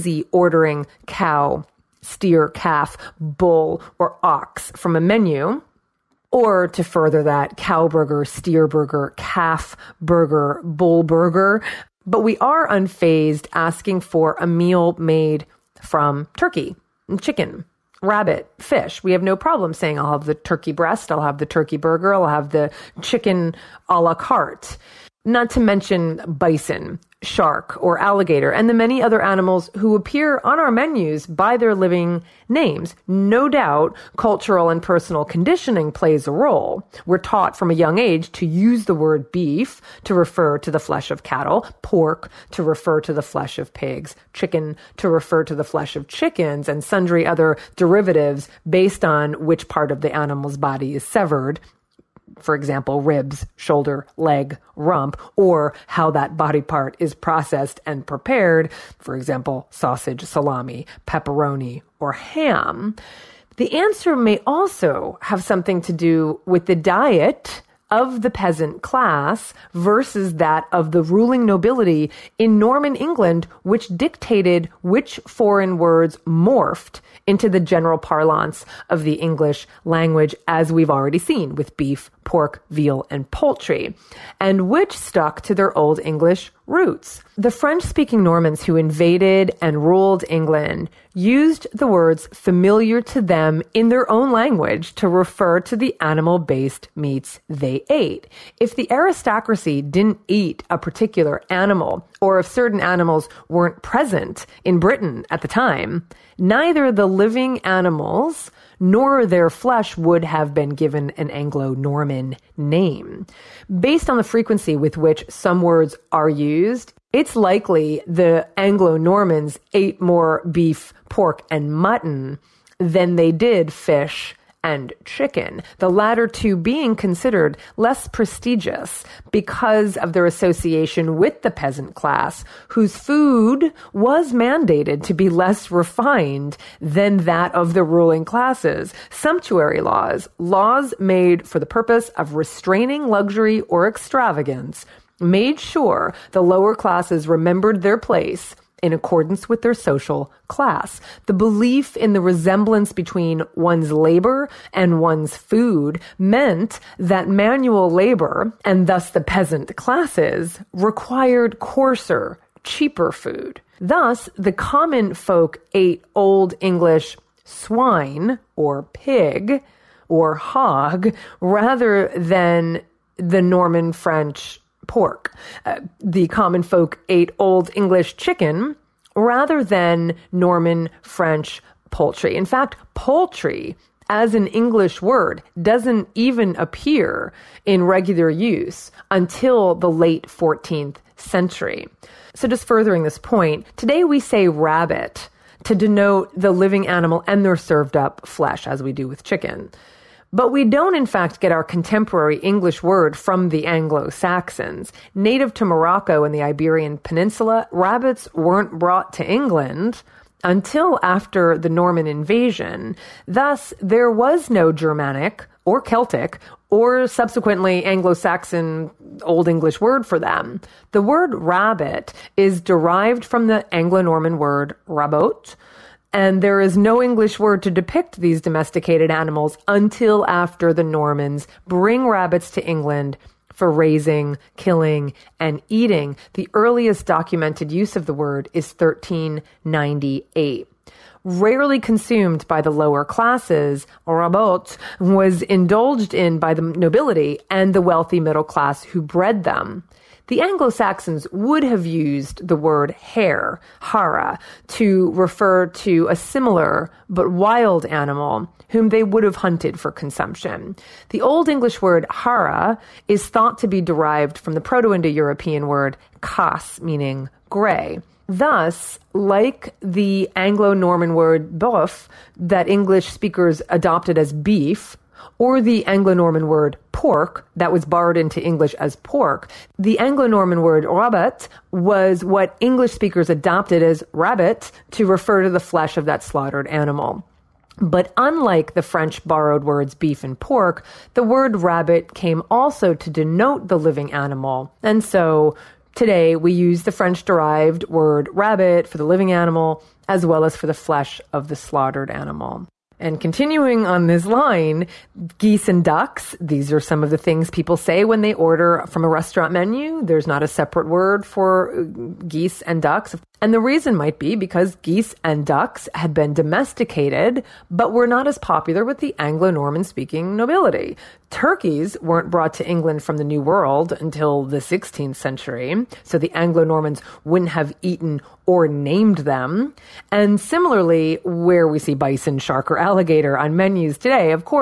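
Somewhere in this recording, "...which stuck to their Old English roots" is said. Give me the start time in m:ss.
1:24.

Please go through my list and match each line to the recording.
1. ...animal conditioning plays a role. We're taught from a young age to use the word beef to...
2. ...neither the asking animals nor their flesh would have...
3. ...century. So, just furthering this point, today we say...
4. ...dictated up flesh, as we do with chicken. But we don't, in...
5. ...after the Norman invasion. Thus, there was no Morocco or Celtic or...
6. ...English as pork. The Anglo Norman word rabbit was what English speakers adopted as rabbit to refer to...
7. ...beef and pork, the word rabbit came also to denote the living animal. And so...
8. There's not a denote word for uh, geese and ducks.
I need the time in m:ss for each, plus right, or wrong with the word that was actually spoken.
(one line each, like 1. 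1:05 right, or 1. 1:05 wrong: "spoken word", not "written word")
1. 0:34 wrong: "personal", not "animal"
2. 1:46 wrong: "living", not "asking"
3. 3:11 right
4. 3:17 wrong: "served", not "dictated"
5. 3:31 wrong: "Germanic", not "Morocco"
6. 4:38 right
7. 4:49 right
8. 5:10 wrong: "separate", not "denote".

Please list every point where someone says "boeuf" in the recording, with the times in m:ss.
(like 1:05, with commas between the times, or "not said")
4:31.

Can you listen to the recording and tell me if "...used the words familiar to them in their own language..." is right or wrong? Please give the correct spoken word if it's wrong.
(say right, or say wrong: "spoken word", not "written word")
right.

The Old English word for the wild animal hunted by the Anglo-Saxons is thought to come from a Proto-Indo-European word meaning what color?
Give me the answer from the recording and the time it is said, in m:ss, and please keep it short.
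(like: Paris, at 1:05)
gray, at 4:27.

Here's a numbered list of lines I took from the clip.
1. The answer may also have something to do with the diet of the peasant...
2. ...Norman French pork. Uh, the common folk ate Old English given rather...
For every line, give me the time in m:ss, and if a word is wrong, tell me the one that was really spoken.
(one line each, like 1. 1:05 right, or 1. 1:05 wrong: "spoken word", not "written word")
1. 1:03 right
2. 2:53 wrong: "chicken", not "given".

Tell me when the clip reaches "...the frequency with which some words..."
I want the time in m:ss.
1:54.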